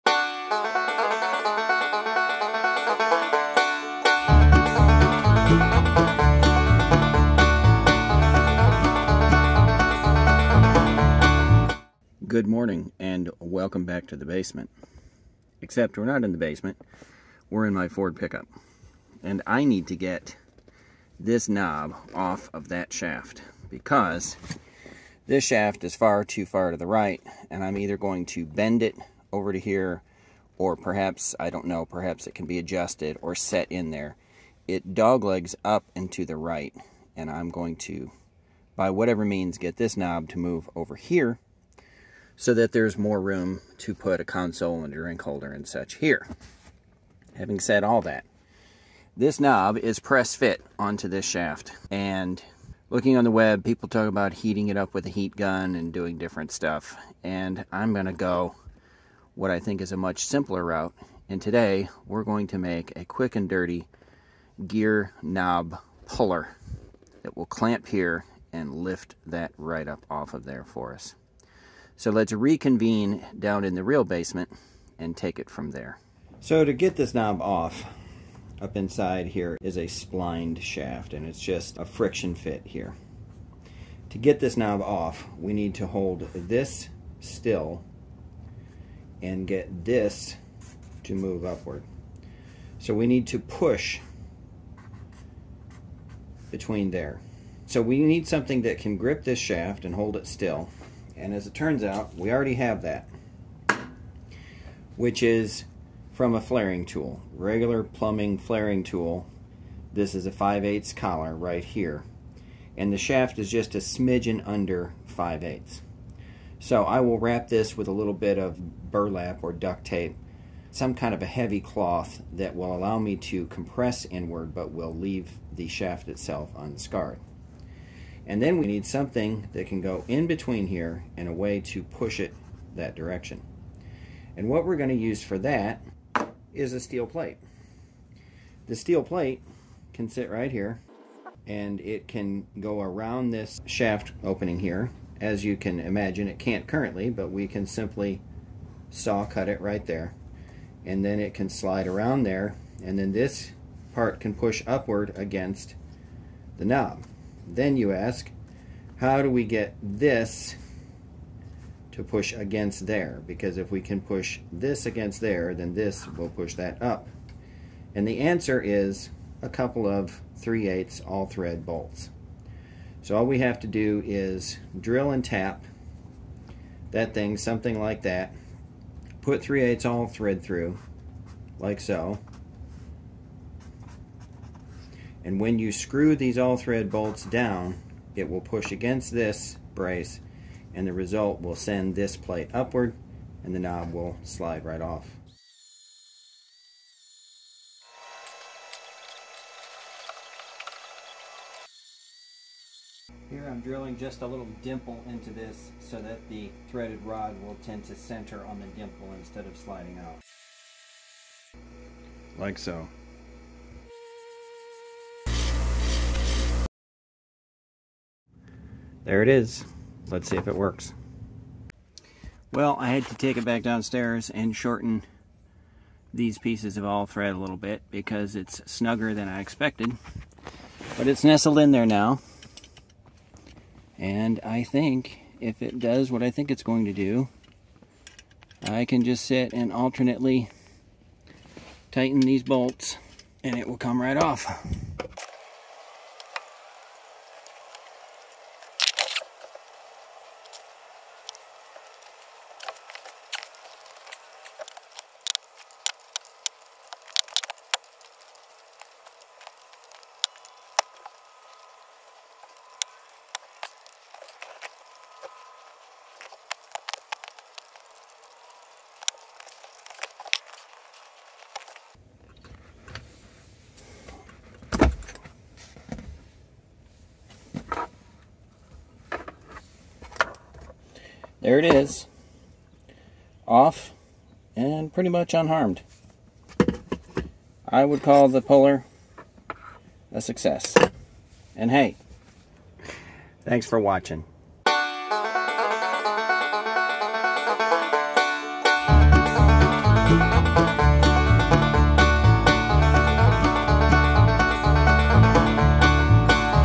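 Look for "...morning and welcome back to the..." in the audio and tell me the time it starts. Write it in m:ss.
0:12.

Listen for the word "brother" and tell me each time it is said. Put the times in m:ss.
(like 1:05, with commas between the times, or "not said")
not said.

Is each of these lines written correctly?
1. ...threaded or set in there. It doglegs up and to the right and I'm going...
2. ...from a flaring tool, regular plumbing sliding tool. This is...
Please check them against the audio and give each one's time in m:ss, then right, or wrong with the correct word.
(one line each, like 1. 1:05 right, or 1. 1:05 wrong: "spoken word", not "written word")
1. 0:32 wrong: "adjusted", not "threaded"
2. 1:46 wrong: "flaring", not "sliding".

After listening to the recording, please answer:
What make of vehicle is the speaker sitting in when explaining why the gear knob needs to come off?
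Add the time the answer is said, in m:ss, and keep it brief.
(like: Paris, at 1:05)
Ford, at 0:17.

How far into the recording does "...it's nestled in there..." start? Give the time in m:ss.
3:51.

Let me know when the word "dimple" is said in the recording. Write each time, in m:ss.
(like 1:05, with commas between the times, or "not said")
3:24, 3:28.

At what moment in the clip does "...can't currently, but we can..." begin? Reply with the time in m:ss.
2:26.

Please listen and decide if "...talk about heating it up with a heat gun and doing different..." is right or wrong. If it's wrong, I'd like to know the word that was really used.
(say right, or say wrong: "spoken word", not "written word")
right.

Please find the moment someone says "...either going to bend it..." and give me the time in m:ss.
0:27.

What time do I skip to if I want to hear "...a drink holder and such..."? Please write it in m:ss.
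0:44.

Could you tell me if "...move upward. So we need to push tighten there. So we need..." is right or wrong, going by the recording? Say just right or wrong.
wrong.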